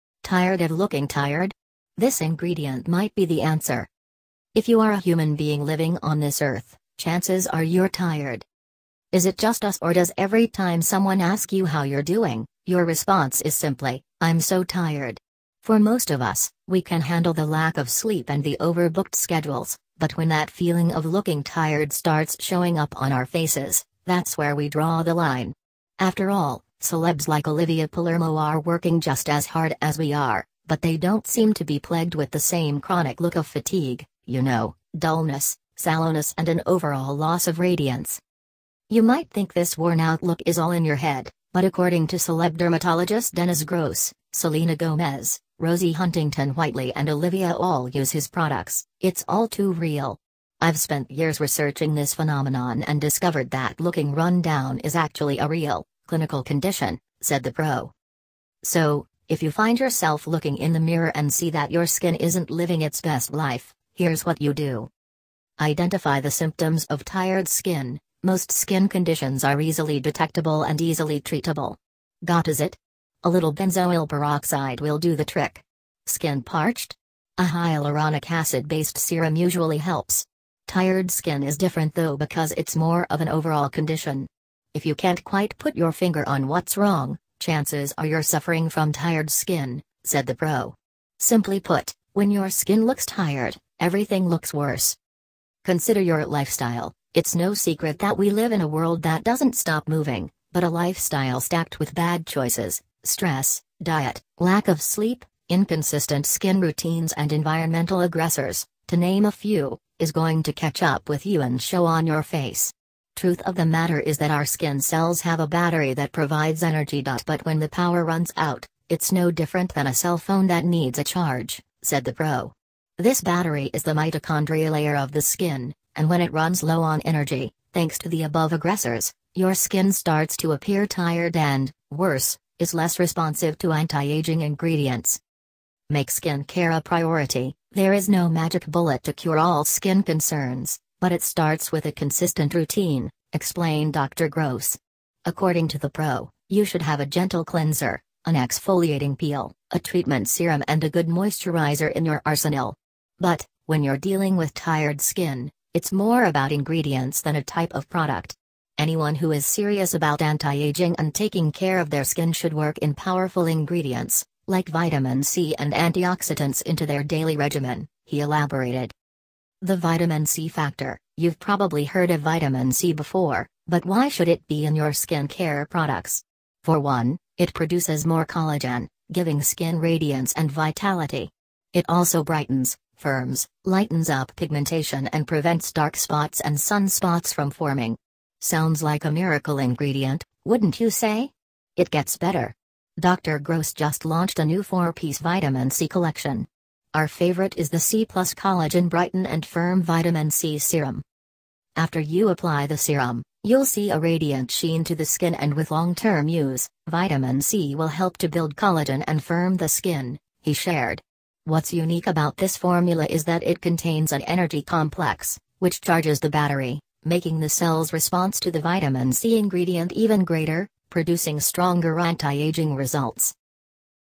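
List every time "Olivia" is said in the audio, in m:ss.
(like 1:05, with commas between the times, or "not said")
0:27, 0:47.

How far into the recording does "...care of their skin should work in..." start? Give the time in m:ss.
2:41.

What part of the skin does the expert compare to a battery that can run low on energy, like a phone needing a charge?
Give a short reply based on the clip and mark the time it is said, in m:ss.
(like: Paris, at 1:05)
mitochondria layer, at 2:03.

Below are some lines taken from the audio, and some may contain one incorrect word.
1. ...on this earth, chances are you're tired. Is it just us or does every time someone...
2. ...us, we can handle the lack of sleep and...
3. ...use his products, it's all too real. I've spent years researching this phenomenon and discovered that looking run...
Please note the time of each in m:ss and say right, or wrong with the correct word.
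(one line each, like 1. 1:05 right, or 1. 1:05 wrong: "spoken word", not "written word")
1. 0:06 right
2. 0:16 right
3. 0:47 right.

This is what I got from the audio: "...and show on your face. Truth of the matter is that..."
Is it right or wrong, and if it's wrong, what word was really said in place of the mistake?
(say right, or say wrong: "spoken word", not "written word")
right.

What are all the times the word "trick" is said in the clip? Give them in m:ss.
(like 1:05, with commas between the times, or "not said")
1:15.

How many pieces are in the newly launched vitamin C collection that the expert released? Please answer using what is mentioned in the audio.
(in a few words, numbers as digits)
4.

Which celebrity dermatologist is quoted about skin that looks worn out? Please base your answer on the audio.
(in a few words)
Dennis Gross.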